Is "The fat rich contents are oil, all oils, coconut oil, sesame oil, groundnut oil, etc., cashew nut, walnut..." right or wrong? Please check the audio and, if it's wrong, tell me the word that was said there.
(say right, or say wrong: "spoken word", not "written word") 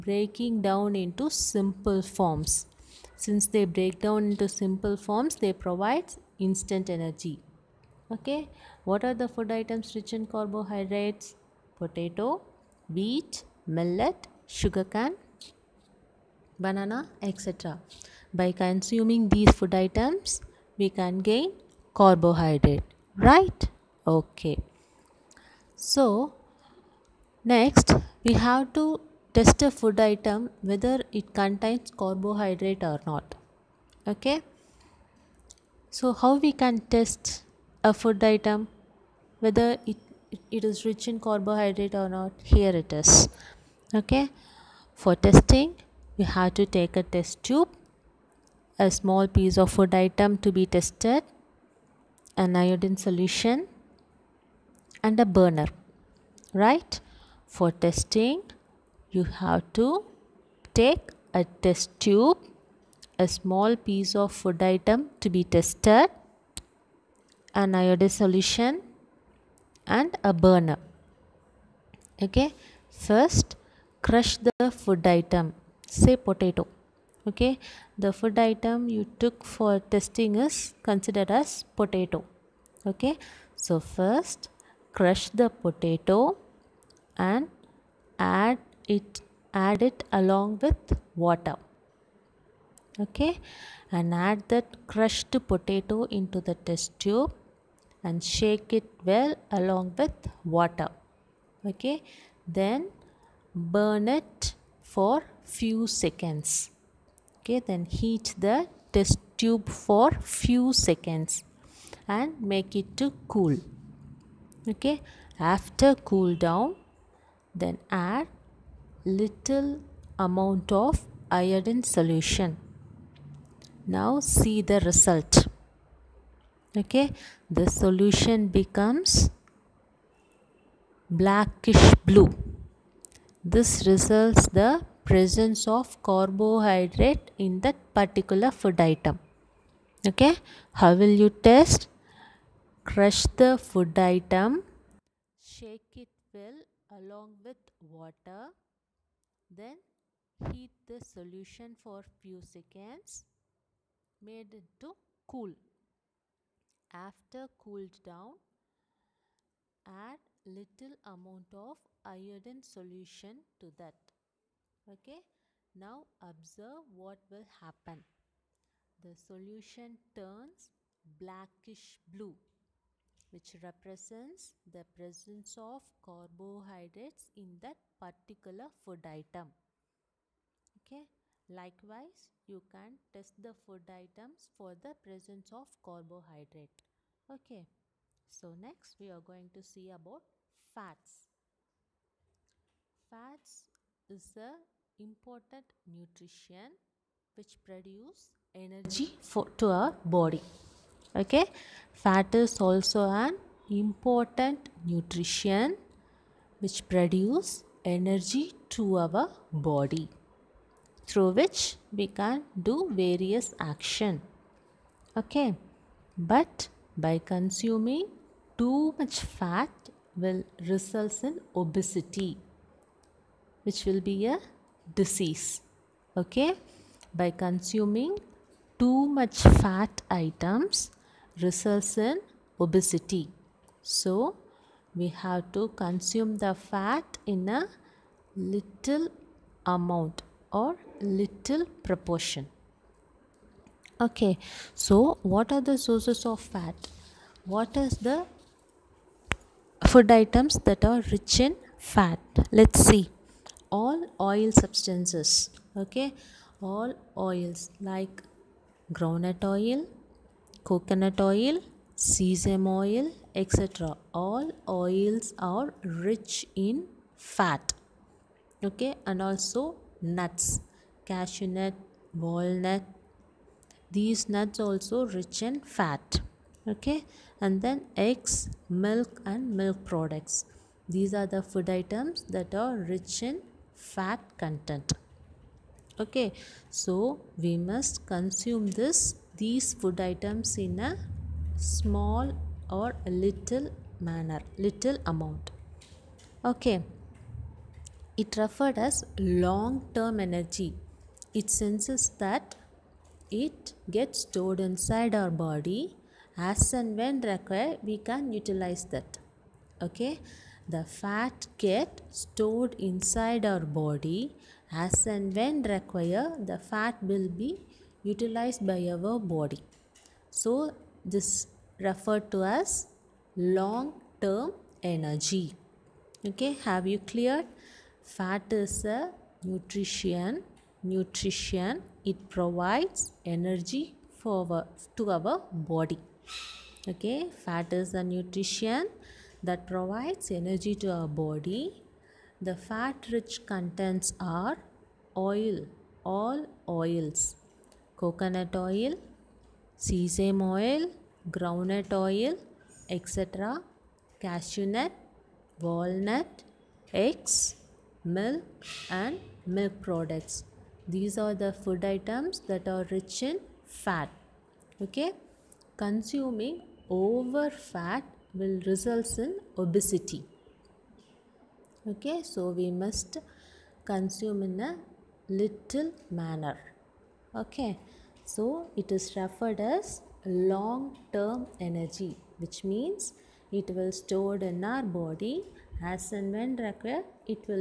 right.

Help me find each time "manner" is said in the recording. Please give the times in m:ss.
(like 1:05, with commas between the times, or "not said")
4:54, 6:16.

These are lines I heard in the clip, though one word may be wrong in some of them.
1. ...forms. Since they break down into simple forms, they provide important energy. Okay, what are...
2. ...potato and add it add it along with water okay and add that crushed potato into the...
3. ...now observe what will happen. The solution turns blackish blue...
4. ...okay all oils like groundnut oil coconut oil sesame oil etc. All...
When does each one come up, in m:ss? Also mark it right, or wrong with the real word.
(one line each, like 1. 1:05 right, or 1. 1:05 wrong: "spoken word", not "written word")
1. 0:02 wrong: "instant", not "important"
2. 1:25 right
3. 2:45 right
4. 4:15 right.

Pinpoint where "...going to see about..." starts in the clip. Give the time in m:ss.
3:09.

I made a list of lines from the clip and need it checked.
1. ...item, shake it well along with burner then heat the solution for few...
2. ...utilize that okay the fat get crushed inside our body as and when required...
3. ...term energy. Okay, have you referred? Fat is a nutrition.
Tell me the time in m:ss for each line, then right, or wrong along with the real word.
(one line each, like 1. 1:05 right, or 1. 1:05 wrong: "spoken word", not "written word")
1. 2:23 wrong: "water", not "burner"
2. 5:08 wrong: "stored", not "crushed"
3. 5:24 wrong: "cleared", not "referred".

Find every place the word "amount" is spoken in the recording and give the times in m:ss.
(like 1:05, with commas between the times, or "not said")
2:00, 2:41, 3:59, 4:55.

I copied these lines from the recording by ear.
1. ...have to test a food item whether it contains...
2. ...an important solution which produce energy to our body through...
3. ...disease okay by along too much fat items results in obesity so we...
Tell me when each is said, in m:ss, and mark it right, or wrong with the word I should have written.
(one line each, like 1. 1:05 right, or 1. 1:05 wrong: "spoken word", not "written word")
1. 0:28 right
2. 3:23 wrong: "nutrition", not "solution"
3. 3:45 wrong: "consuming", not "along".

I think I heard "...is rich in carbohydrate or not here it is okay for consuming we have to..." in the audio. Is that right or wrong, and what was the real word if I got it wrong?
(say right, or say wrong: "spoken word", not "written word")
wrong: "testing", not "consuming".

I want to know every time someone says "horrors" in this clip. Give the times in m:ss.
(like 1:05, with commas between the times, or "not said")
not said.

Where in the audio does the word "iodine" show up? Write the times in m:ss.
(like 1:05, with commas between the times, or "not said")
0:52, 1:07, 2:01, 2:42.